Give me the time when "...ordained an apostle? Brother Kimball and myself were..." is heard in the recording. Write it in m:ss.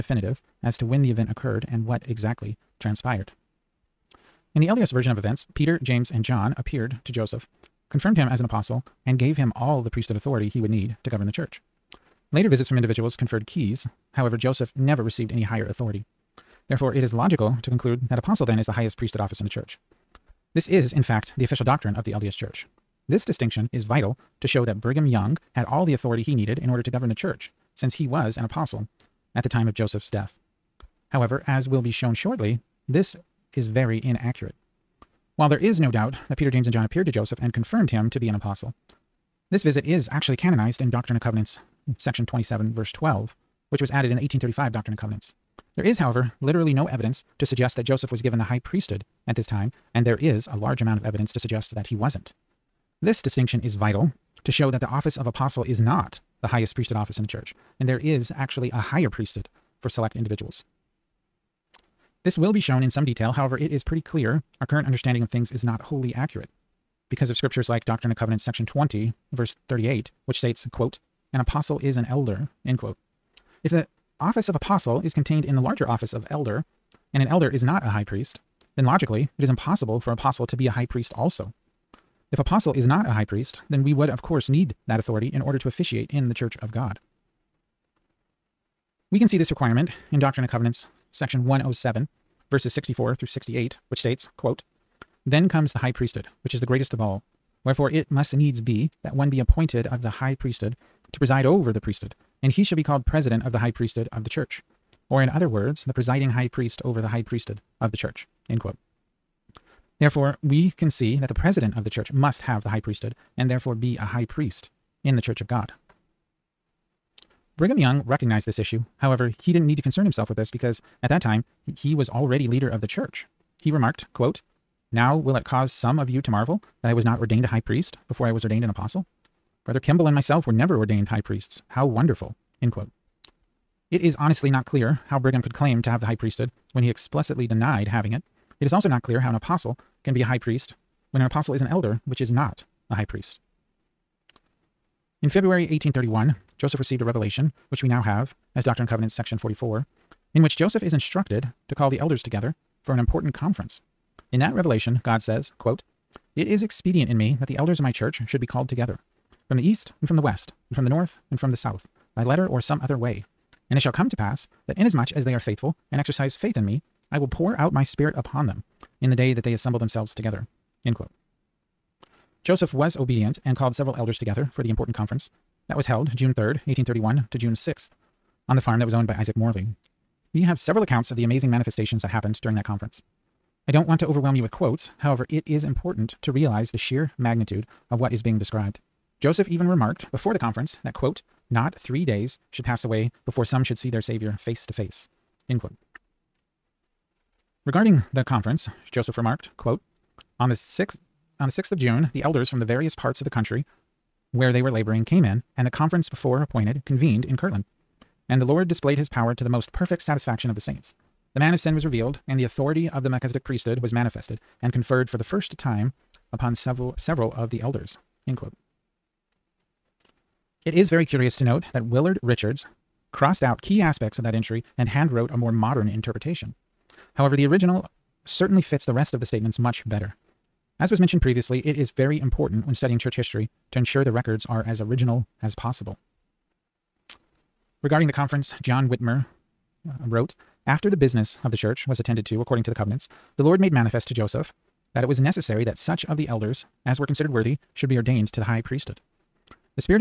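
2:08.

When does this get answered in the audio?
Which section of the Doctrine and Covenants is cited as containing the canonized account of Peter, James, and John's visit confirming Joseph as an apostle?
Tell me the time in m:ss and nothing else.
0:41.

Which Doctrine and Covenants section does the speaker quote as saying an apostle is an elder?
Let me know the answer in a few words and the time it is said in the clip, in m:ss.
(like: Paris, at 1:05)
Section 20, at 1:08.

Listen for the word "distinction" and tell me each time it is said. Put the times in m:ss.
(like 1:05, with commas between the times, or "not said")
0:23, 0:53.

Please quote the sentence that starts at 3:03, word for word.
I don't want to overwhelm you with quotes, however, it is important to realize the sheer magnitude of what is being described.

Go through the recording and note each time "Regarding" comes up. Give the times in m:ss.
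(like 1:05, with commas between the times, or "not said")
3:17, 3:57.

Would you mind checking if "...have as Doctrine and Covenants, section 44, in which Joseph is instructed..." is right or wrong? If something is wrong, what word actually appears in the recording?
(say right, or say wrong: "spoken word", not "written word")
right.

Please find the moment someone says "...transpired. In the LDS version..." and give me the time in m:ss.
0:02.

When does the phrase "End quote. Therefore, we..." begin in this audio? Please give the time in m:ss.
1:48.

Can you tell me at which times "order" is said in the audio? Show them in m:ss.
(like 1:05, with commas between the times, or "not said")
0:26, 1:25.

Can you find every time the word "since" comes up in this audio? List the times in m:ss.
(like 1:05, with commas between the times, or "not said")
0:27.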